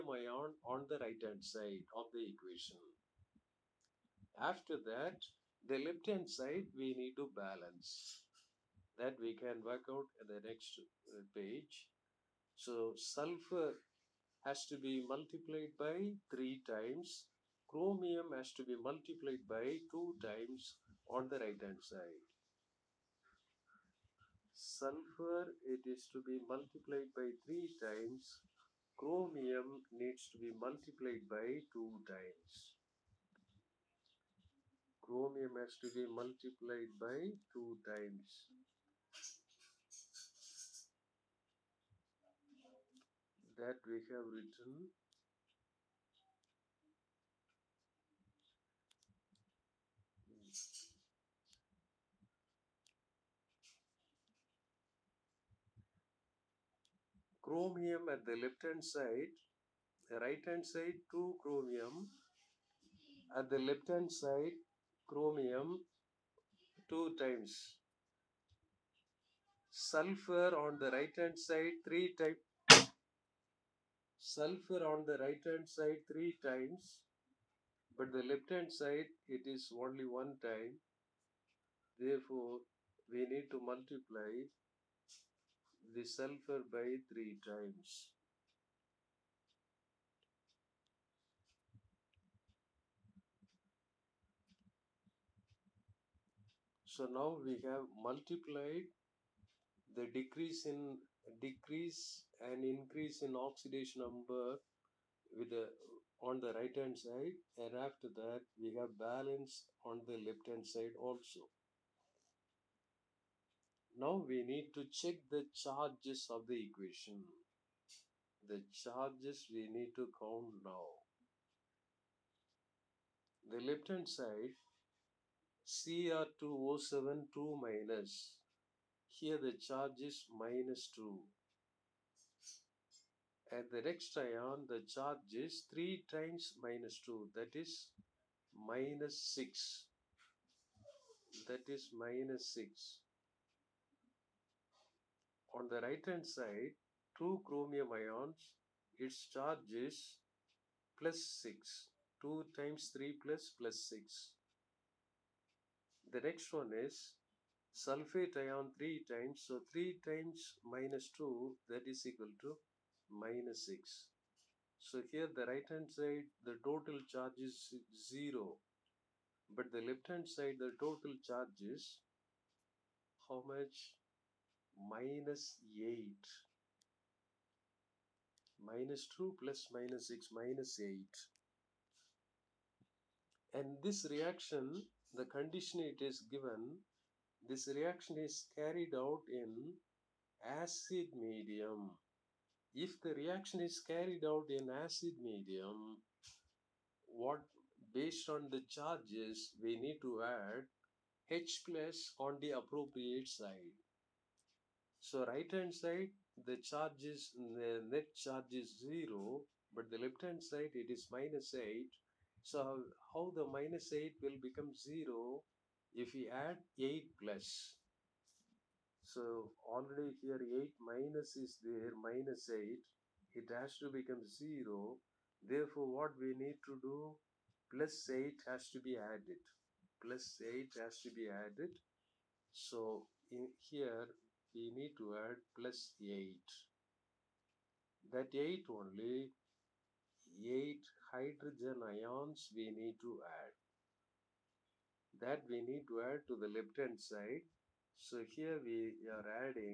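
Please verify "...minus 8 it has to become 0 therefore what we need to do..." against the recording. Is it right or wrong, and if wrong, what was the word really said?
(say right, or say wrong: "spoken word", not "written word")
right.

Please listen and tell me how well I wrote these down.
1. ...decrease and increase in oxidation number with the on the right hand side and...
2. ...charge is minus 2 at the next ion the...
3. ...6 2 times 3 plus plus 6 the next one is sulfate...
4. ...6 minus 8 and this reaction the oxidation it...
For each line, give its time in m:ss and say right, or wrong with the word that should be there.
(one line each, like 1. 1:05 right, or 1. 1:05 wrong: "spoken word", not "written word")
1. 1:41 right
2. 2:09 right
3. 2:31 right
4. 3:00 wrong: "condition", not "oxidation".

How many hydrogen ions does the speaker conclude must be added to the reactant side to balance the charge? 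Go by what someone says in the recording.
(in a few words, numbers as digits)
8.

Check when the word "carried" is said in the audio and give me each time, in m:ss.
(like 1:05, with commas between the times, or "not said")
3:08, 3:13.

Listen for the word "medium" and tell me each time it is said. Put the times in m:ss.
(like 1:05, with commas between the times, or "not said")
3:11, 3:15.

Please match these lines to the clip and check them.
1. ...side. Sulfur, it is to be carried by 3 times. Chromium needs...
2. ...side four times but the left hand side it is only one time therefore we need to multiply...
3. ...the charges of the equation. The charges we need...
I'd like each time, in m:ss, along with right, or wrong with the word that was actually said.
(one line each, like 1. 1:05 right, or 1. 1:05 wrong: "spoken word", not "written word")
1. 0:21 wrong: "multiplied", not "carried"
2. 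1:15 wrong: "three", not "four"
3. 1:55 right.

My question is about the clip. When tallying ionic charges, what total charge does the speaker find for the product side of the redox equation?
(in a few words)
0.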